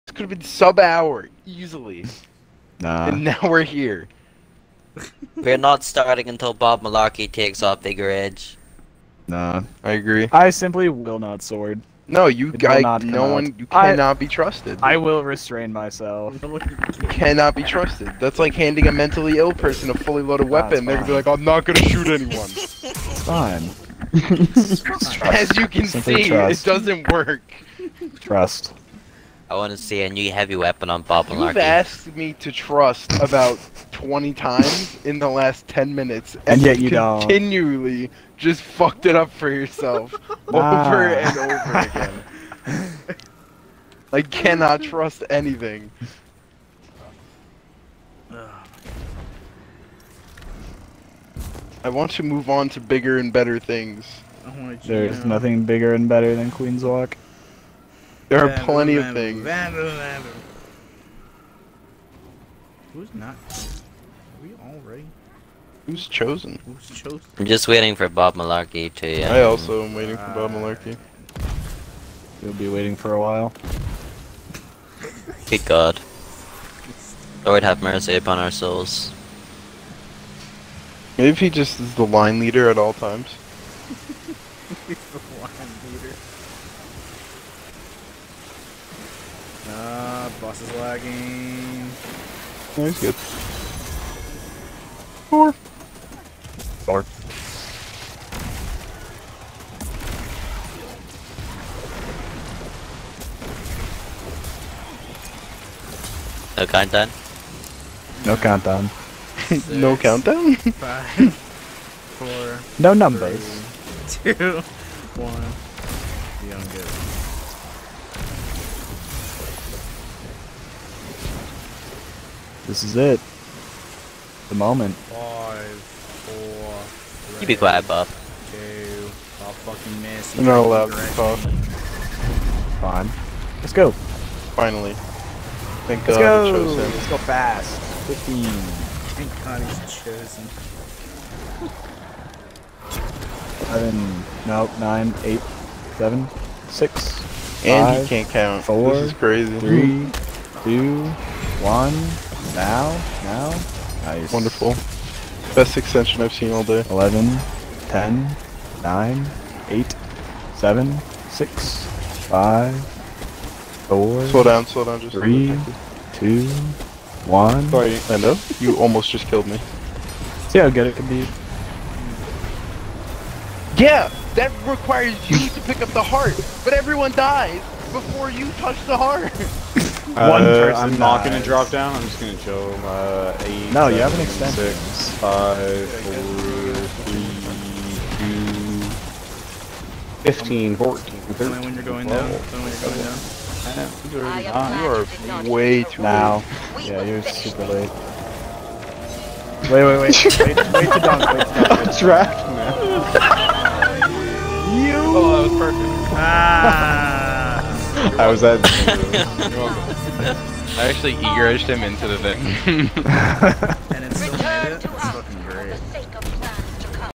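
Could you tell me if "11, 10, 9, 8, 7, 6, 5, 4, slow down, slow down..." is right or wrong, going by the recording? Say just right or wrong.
right.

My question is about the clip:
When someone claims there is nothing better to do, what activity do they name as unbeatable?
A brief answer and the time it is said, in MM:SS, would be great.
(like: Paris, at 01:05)
Queenswalk, at 00:56.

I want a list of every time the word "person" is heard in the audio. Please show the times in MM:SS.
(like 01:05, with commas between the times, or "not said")
00:19, 03:00.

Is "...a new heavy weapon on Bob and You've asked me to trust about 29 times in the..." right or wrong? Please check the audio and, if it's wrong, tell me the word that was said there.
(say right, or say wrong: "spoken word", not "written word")
wrong: "20", not "29".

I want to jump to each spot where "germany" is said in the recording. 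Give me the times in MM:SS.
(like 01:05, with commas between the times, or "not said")
not said.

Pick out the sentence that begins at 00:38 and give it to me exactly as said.
just fucked it up for yourself nah.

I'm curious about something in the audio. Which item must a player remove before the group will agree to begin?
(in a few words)
Bigger Edge.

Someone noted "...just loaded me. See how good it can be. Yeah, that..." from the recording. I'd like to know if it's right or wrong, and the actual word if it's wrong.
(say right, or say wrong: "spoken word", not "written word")
wrong: "killed", not "loaded".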